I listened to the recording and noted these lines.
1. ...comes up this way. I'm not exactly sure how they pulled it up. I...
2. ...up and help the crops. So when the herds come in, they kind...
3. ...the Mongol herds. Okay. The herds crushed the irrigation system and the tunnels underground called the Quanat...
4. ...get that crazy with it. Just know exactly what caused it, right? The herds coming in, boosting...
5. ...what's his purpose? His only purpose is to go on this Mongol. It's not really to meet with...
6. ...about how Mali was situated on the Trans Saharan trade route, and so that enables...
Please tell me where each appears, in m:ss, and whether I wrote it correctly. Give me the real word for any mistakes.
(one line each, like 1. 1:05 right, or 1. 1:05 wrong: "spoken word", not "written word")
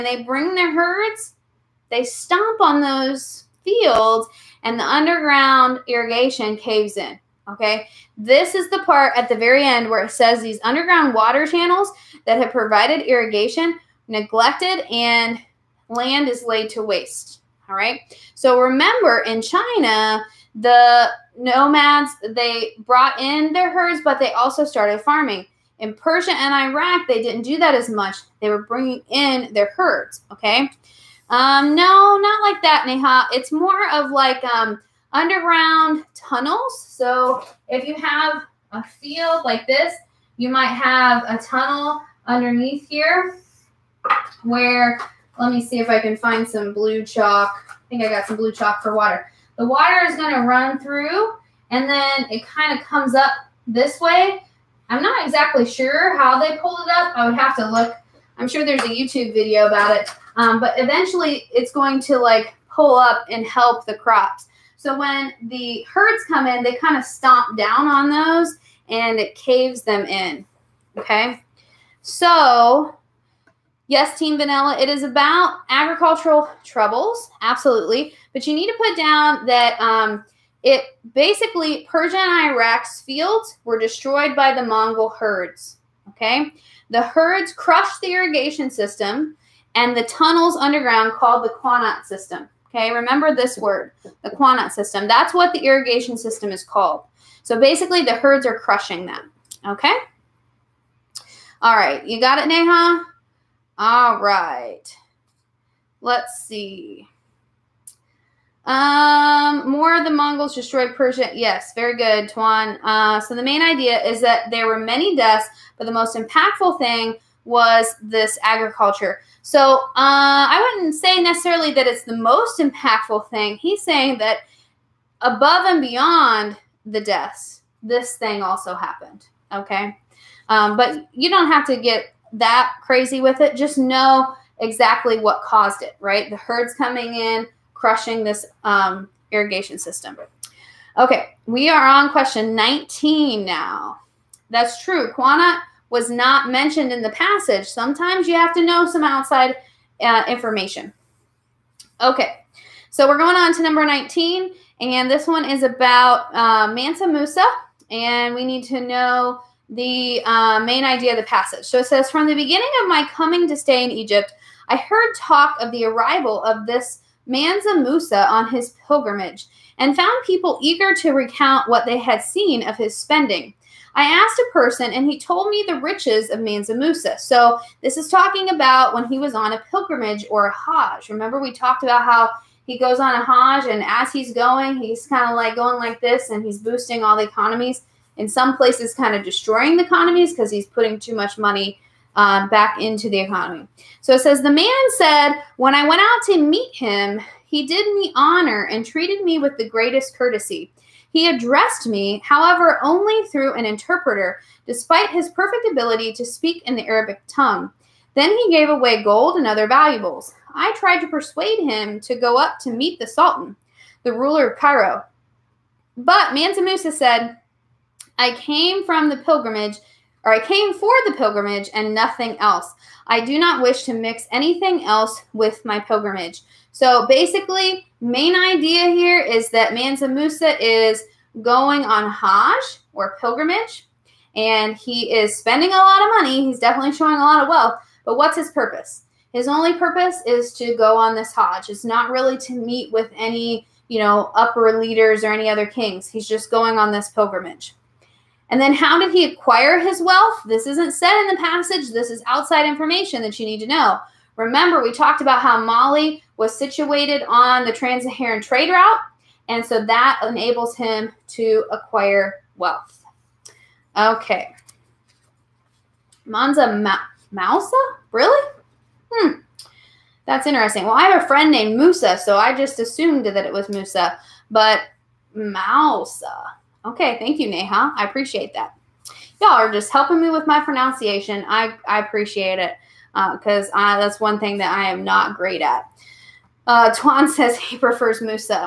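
1. 0:52 right
2. 1:02 right
3. 1:24 right
4. 2:11 wrong: "crushing", not "boosting"
5. 3:58 wrong: "Hajj", not "Mongol"
6. 4:15 right.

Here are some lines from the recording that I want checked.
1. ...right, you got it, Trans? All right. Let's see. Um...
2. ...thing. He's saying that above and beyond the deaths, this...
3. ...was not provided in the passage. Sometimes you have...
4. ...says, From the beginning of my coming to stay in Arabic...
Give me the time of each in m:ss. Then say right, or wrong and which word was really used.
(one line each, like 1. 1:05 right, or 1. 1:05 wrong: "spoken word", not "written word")
1. 1:41 wrong: "Neha", not "Trans"
2. 2:03 right
3. 2:25 wrong: "mentioned", not "provided"
4. 2:41 wrong: "Egypt", not "Arabic".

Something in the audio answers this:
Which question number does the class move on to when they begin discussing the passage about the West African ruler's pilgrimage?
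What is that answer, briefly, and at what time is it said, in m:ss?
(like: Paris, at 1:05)
19, at 2:22.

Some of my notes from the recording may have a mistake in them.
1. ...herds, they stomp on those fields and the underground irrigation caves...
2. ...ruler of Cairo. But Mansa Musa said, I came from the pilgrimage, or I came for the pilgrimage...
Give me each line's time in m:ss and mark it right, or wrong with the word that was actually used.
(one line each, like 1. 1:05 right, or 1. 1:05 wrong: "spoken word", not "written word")
1. 0:00 right
2. 3:34 right.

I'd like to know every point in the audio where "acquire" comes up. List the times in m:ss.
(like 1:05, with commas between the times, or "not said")
4:09, 4:21.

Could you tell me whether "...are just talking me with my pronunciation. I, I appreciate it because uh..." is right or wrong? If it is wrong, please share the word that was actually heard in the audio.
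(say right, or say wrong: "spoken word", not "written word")
wrong: "helping", not "talking".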